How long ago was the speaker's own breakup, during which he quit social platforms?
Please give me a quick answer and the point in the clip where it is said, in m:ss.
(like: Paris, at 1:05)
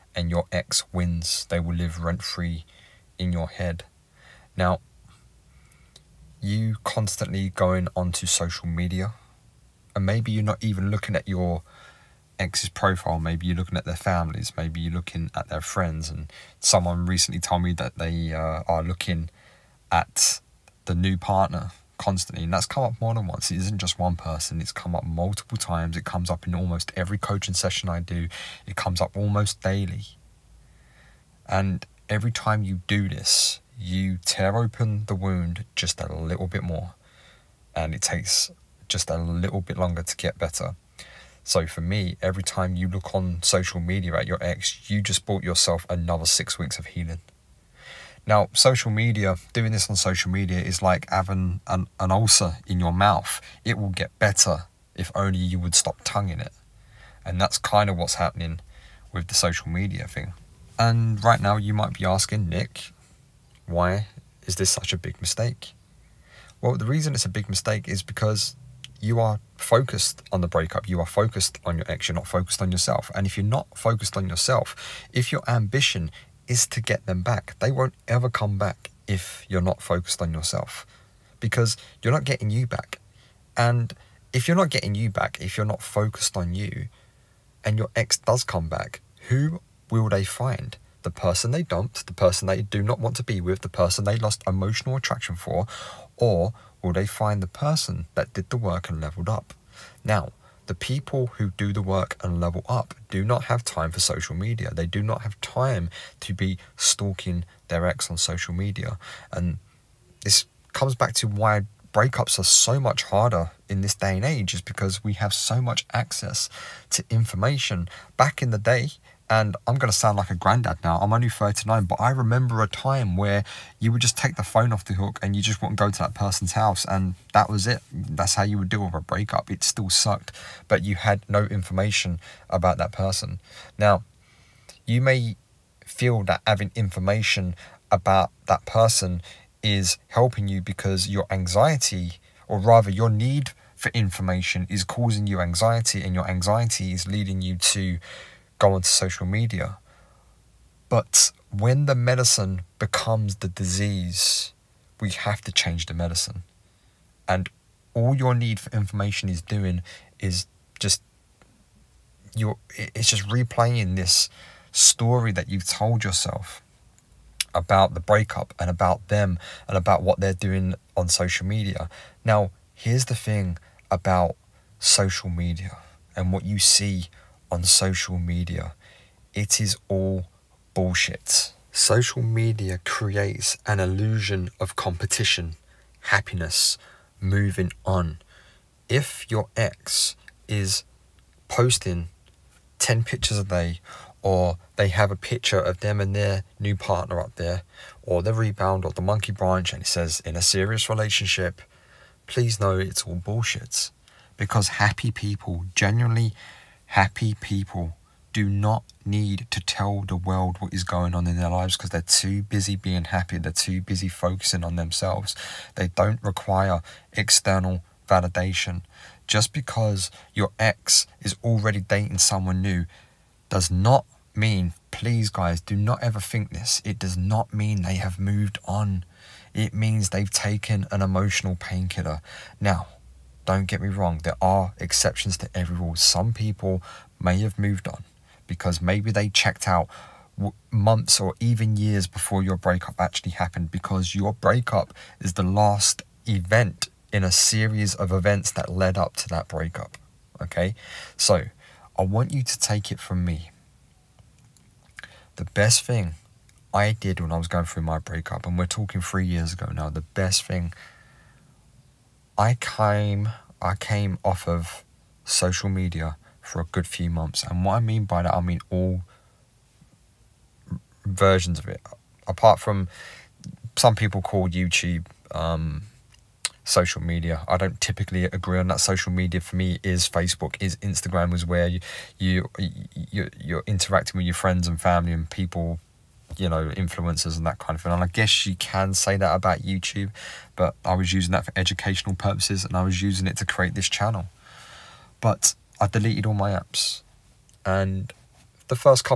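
3 years ago, at 4:19.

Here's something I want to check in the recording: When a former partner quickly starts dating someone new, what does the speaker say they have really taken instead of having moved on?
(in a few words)
An emotional painkiller.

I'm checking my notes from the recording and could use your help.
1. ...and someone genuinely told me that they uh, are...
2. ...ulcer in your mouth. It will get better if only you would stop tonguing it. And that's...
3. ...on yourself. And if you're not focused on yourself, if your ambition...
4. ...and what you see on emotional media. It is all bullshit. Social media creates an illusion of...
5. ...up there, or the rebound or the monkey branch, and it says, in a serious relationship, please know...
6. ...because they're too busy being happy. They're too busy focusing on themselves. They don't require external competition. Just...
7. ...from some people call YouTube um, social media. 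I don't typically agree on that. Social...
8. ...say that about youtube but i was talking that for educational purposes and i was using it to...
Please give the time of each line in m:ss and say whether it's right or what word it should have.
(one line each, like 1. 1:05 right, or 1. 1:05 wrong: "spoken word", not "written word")
1. 0:16 wrong: "recently", not "genuinely"
2. 0:52 right
3. 1:12 right
4. 2:56 wrong: "social", not "emotional"
5. 3:17 right
6. 3:31 wrong: "validation", not "competition"
7. 4:32 right
8. 4:48 wrong: "using", not "talking".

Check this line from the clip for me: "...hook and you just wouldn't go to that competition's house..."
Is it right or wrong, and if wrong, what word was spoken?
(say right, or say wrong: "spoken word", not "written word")
wrong: "person", not "competition".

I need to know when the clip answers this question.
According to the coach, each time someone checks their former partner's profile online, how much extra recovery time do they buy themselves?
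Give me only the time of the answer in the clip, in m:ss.
0:46.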